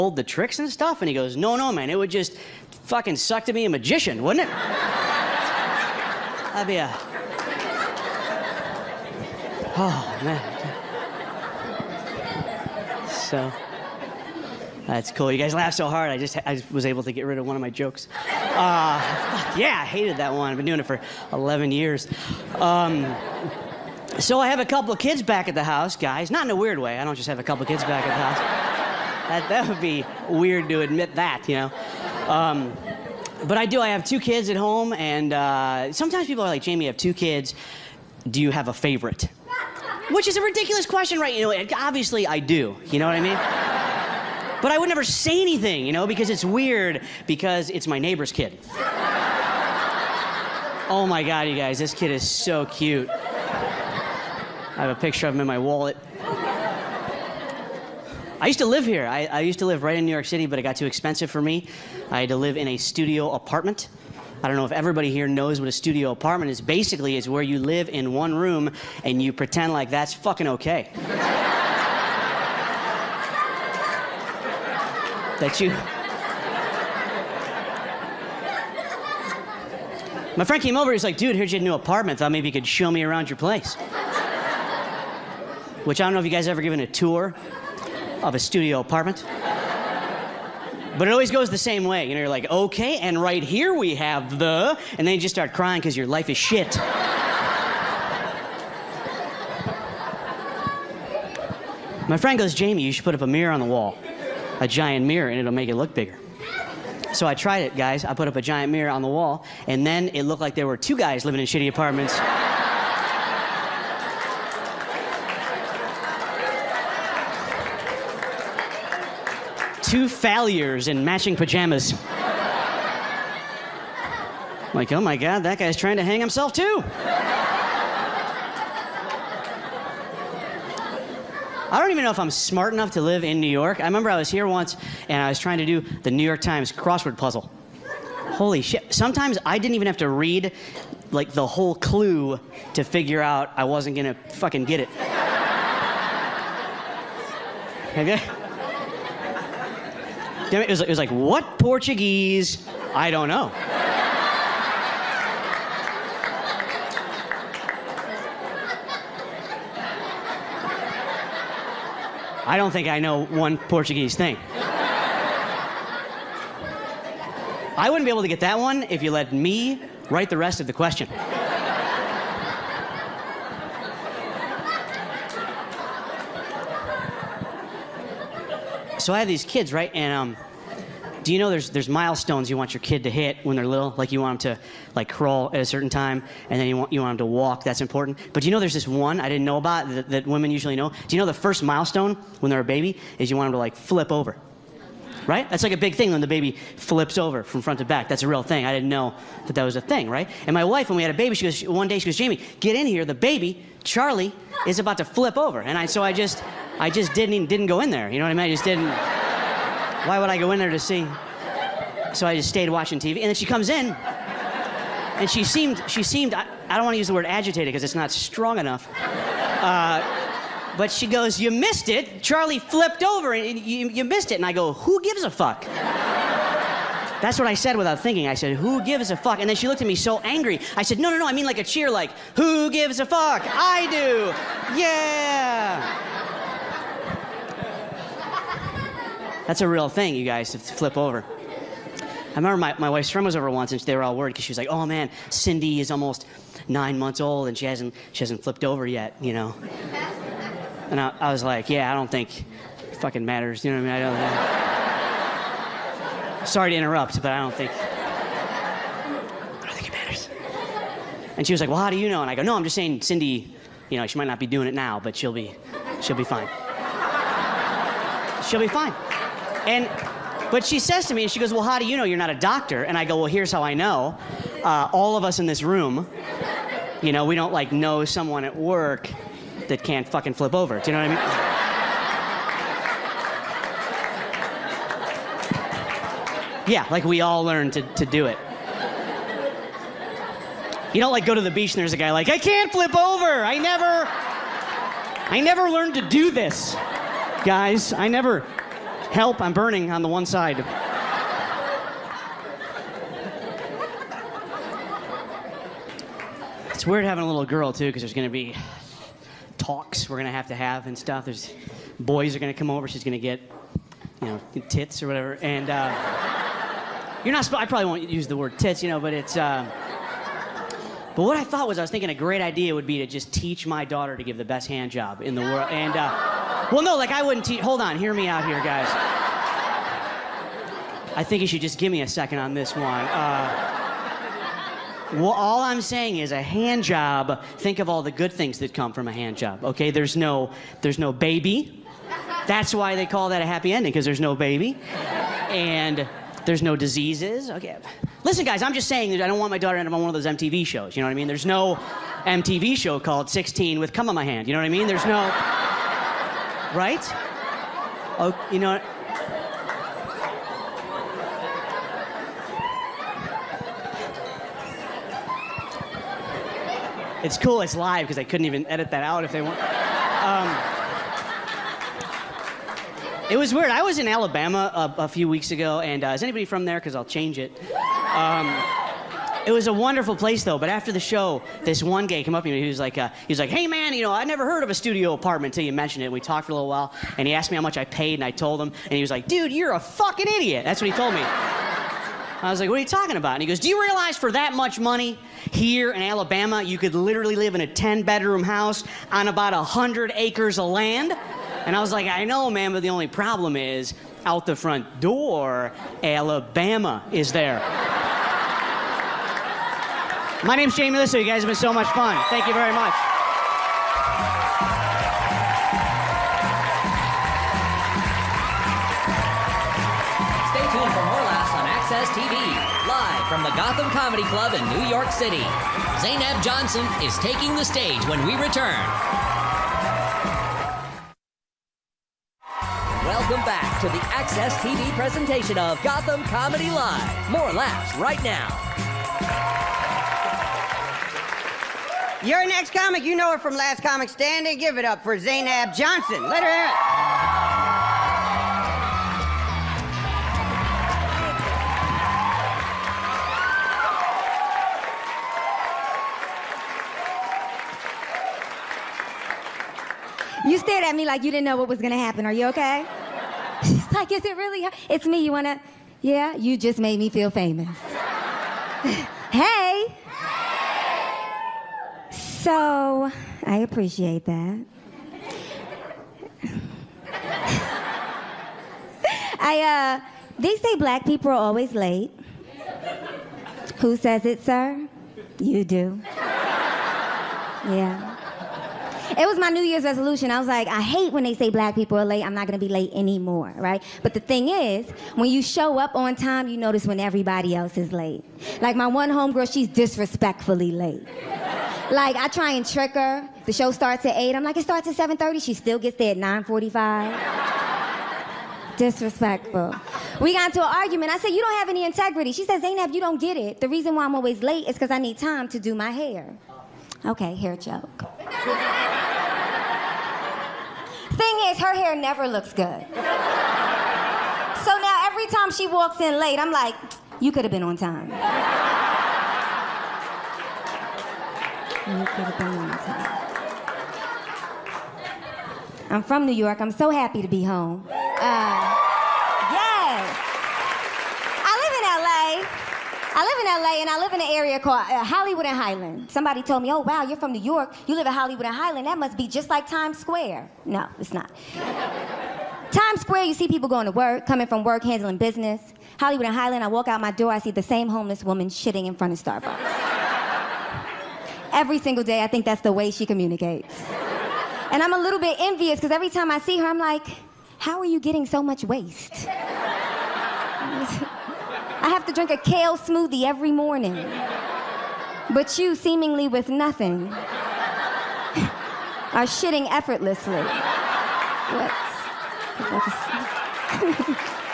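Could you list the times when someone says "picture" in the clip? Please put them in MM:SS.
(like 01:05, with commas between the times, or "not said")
00:54.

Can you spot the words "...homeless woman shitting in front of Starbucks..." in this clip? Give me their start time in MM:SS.
09:17.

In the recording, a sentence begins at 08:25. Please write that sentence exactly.
She still gets there at 9:45.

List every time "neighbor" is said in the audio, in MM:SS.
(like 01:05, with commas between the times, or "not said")
00:47.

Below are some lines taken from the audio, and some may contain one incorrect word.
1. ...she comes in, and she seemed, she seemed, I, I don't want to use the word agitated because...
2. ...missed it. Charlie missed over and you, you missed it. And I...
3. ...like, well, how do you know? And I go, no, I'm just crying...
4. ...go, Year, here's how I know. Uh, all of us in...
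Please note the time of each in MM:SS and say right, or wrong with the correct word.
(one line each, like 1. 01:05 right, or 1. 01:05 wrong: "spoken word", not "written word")
1. 03:33 right
2. 03:41 wrong: "flipped", not "missed"
3. 04:21 wrong: "saying", not "crying"
4. 04:33 wrong: "Well", not "Year".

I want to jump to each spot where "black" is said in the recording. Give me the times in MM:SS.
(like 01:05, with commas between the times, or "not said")
08:00, 08:11.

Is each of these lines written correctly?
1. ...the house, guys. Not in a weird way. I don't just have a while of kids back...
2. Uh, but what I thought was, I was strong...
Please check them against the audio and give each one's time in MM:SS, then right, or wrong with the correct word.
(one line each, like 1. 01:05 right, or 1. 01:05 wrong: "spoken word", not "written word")
1. 00:25 wrong: "couple", not "while"
2. 05:19 wrong: "thinking", not "strong".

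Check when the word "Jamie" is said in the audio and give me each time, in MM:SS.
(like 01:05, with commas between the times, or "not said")
00:36, 01:42, 03:22, 06:50.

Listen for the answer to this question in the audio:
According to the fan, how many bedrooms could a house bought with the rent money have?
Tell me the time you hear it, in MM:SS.
06:37.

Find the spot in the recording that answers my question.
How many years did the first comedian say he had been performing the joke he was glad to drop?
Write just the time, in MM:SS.
00:21.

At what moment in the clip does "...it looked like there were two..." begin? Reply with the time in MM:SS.
01:50.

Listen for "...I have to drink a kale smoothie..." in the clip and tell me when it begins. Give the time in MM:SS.
09:29.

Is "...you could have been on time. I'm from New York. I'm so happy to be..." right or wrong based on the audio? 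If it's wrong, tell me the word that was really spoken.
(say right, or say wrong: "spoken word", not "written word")
right.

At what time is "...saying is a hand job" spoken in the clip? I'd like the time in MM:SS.
05:35.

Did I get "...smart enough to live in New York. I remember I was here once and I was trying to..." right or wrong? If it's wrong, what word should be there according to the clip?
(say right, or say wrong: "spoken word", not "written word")
right.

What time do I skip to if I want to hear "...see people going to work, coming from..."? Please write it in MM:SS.
09:13.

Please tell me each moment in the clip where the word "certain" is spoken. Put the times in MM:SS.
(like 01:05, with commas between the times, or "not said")
03:05.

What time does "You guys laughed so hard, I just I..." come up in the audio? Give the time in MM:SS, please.
00:15.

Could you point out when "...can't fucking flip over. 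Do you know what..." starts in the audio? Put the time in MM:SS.
04:39.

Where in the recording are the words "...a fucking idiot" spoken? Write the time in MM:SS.
06:29.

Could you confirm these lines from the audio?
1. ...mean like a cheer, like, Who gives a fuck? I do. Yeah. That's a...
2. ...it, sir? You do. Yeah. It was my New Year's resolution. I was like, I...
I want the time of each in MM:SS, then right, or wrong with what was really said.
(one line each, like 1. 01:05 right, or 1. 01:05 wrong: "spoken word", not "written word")
1. 03:51 right
2. 08:04 right.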